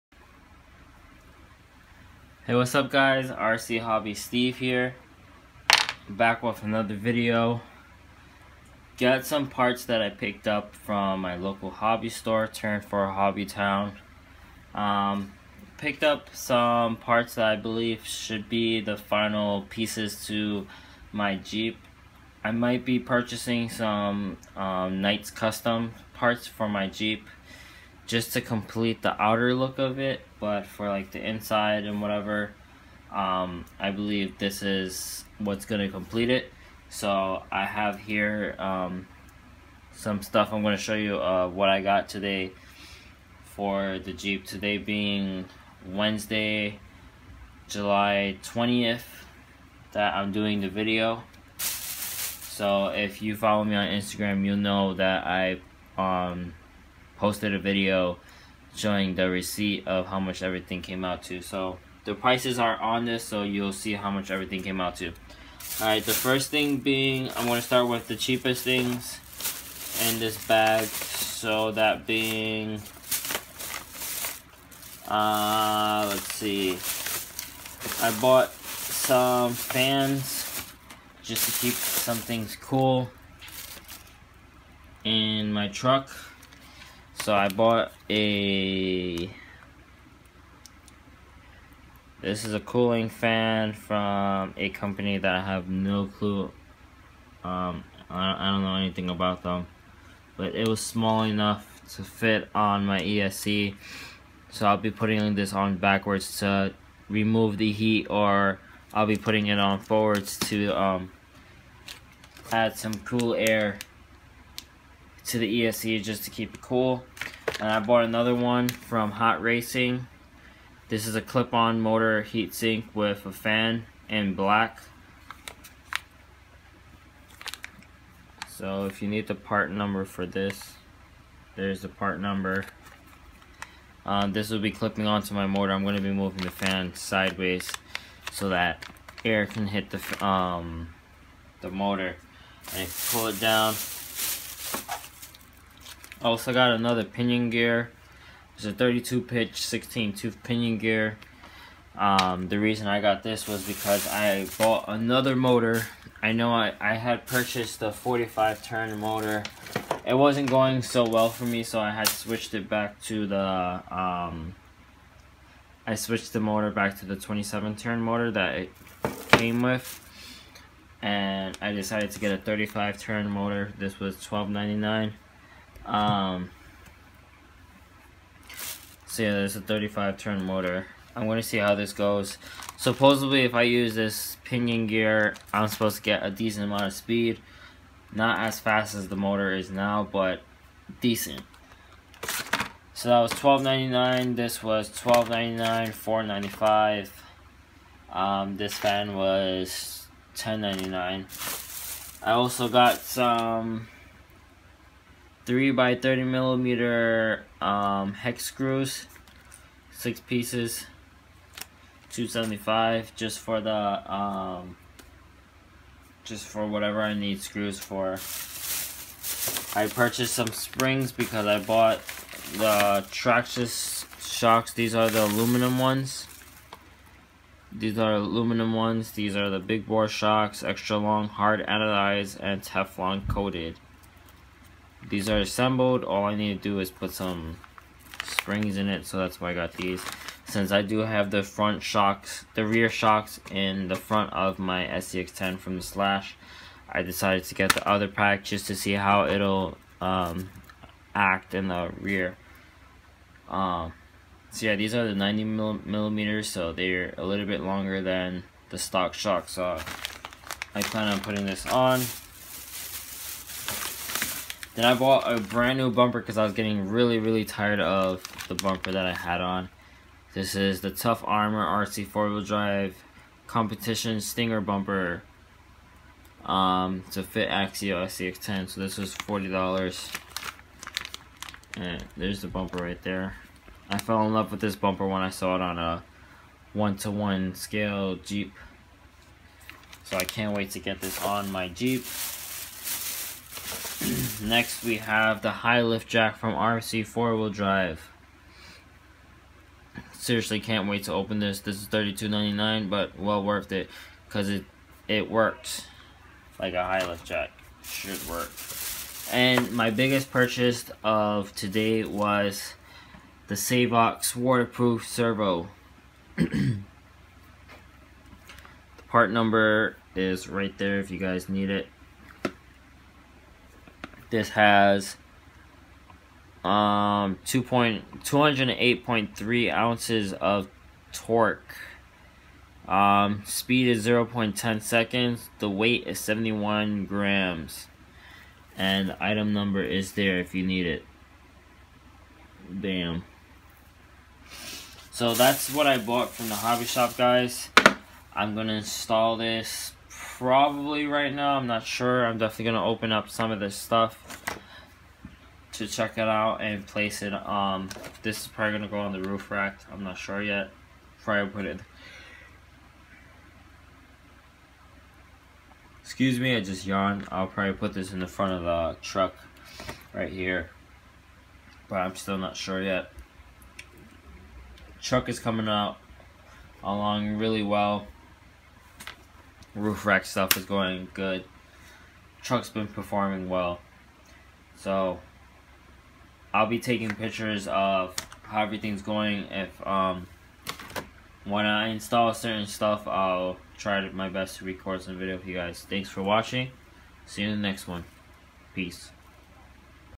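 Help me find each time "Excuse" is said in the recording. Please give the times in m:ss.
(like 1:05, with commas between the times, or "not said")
6:06.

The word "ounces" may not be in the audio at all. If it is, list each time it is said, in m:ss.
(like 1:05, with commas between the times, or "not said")
5:29.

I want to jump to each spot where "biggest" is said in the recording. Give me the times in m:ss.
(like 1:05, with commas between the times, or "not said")
5:09.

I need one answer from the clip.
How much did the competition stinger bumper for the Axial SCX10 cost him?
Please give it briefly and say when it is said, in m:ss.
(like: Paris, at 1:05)
$40, at 4:39.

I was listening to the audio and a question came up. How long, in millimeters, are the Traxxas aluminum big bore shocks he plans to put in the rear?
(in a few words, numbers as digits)
90 millimeters.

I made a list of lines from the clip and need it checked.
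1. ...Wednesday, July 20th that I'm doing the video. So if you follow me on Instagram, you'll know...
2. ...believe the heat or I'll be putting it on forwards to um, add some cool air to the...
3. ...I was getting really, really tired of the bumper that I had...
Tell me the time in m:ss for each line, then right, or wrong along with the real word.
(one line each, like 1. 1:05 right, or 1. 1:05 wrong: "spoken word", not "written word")
1. 0:45 right
2. 1:47 wrong: "remove", not "believe"
3. 4:26 right.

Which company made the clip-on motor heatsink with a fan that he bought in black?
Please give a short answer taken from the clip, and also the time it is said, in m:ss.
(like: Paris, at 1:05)
Hot Racing, at 1:59.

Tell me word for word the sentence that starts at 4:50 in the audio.
So I can't wait to get this on my Jeep.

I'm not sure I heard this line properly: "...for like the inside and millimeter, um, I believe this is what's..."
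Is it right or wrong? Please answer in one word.
wrong.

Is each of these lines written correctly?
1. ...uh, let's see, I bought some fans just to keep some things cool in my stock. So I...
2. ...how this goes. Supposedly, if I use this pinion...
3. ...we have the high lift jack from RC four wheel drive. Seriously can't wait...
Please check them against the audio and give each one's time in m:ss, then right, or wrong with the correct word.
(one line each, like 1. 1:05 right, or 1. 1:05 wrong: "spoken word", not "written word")
1. 1:15 wrong: "truck", not "stock"
2. 3:01 right
3. 4:54 right.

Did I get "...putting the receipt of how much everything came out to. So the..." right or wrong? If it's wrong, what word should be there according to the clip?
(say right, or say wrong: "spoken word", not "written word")
wrong: "showing", not "putting".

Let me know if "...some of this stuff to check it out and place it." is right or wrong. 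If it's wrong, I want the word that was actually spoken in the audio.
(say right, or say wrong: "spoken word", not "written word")
right.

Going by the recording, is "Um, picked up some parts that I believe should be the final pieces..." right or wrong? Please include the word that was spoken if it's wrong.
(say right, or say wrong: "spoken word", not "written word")
right.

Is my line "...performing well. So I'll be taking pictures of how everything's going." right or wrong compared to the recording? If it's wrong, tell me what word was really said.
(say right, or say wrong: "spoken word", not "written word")
right.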